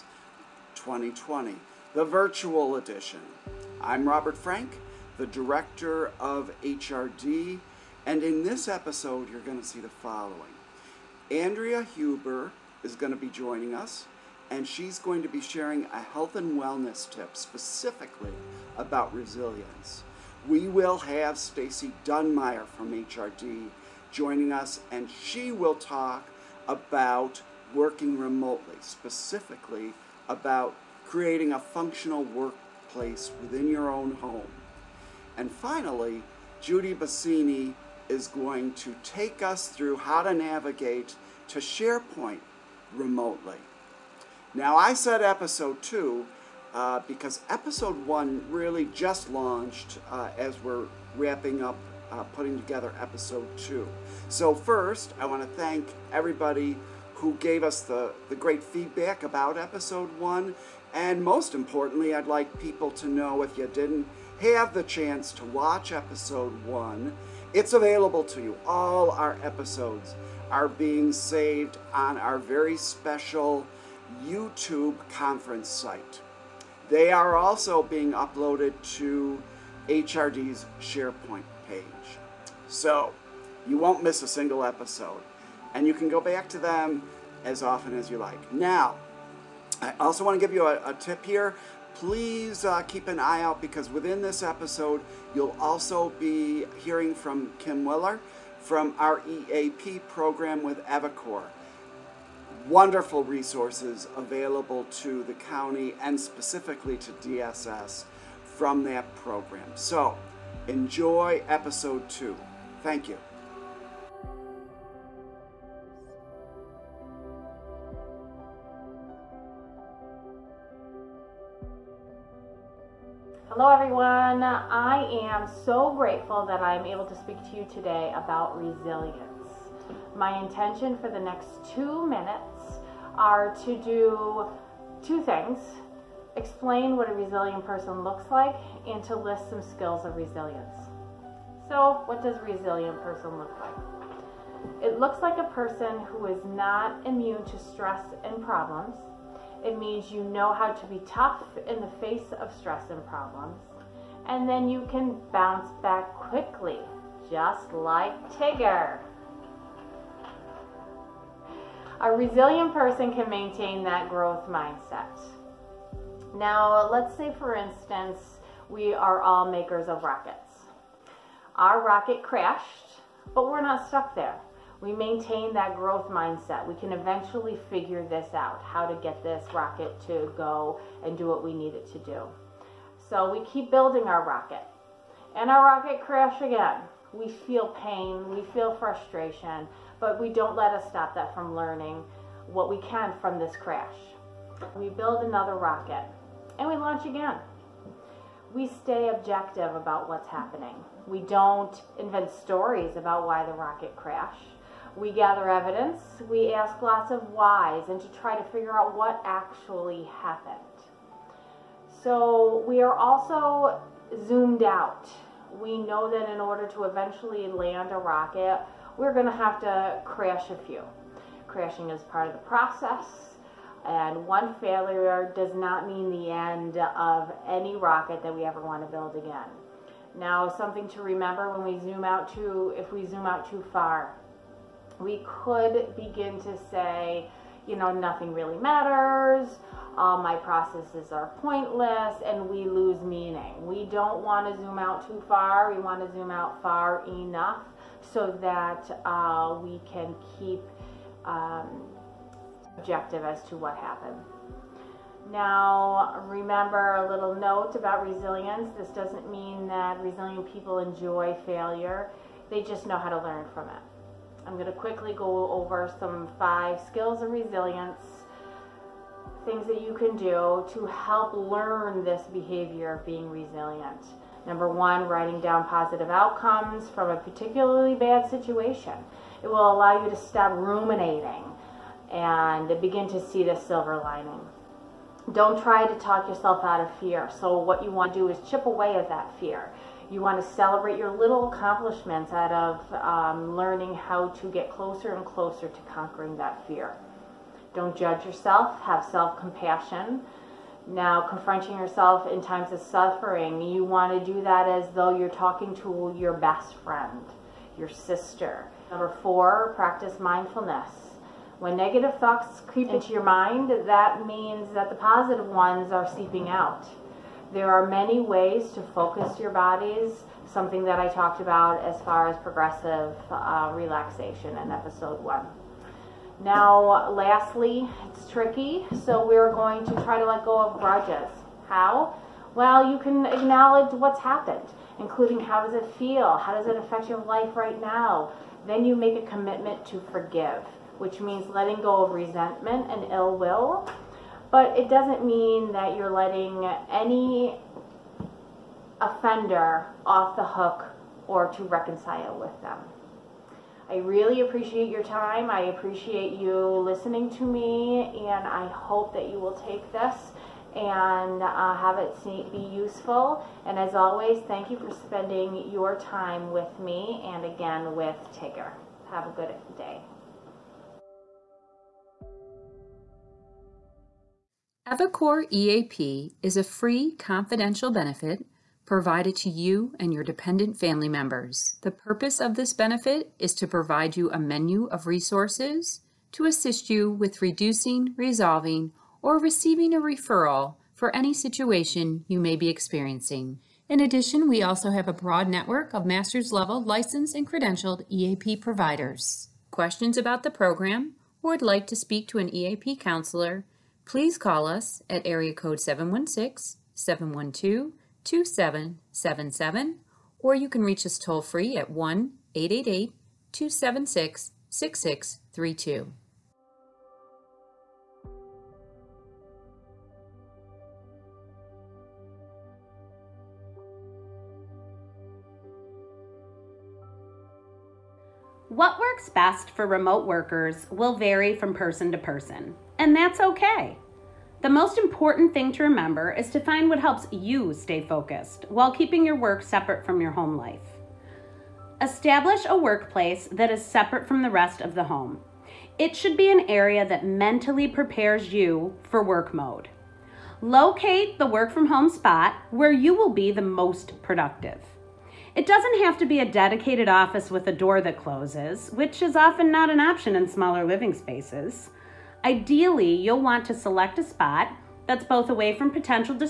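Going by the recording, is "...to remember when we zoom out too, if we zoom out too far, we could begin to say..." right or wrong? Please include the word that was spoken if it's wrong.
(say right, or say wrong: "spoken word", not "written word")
right.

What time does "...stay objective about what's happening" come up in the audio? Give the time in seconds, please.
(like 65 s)
198 s.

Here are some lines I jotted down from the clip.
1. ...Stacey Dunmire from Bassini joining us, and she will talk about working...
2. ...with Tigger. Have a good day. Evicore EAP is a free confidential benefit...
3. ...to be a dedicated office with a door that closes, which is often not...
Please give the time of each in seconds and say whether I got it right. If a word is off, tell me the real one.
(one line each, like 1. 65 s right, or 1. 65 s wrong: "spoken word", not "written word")
1. 21 s wrong: "HRD", not "Bassini"
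2. 367 s right
3. 456 s right.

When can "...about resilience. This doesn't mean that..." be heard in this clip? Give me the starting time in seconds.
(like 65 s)
257 s.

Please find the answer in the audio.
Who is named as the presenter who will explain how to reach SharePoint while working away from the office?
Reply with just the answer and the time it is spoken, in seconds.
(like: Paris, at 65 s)
Judi Bassini, at 36 s.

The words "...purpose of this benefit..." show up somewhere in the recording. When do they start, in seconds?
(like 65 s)
381 s.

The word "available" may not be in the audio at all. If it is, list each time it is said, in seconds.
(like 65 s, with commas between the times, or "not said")
67 s, 104 s.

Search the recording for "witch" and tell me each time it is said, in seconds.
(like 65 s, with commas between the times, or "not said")
not said.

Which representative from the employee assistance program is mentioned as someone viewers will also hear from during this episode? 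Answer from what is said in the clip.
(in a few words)
Kim Willer.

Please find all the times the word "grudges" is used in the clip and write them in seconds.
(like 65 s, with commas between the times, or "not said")
330 s.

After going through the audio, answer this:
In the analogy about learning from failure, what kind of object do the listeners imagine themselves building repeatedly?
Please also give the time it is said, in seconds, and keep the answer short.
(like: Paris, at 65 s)
Rockets, at 170 s.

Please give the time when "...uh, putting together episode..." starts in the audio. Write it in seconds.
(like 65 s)
52 s.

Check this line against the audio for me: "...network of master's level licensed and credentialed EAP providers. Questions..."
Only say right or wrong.
right.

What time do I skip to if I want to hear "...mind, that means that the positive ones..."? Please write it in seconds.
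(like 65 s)
313 s.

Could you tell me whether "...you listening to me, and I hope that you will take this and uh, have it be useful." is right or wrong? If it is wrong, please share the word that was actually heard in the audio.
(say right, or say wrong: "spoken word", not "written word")
right.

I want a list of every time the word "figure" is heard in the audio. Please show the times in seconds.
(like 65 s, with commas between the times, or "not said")
177 s, 208 s.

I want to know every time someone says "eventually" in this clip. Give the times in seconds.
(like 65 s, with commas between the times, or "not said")
176 s, 216 s.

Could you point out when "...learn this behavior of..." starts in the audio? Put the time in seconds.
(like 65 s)
271 s.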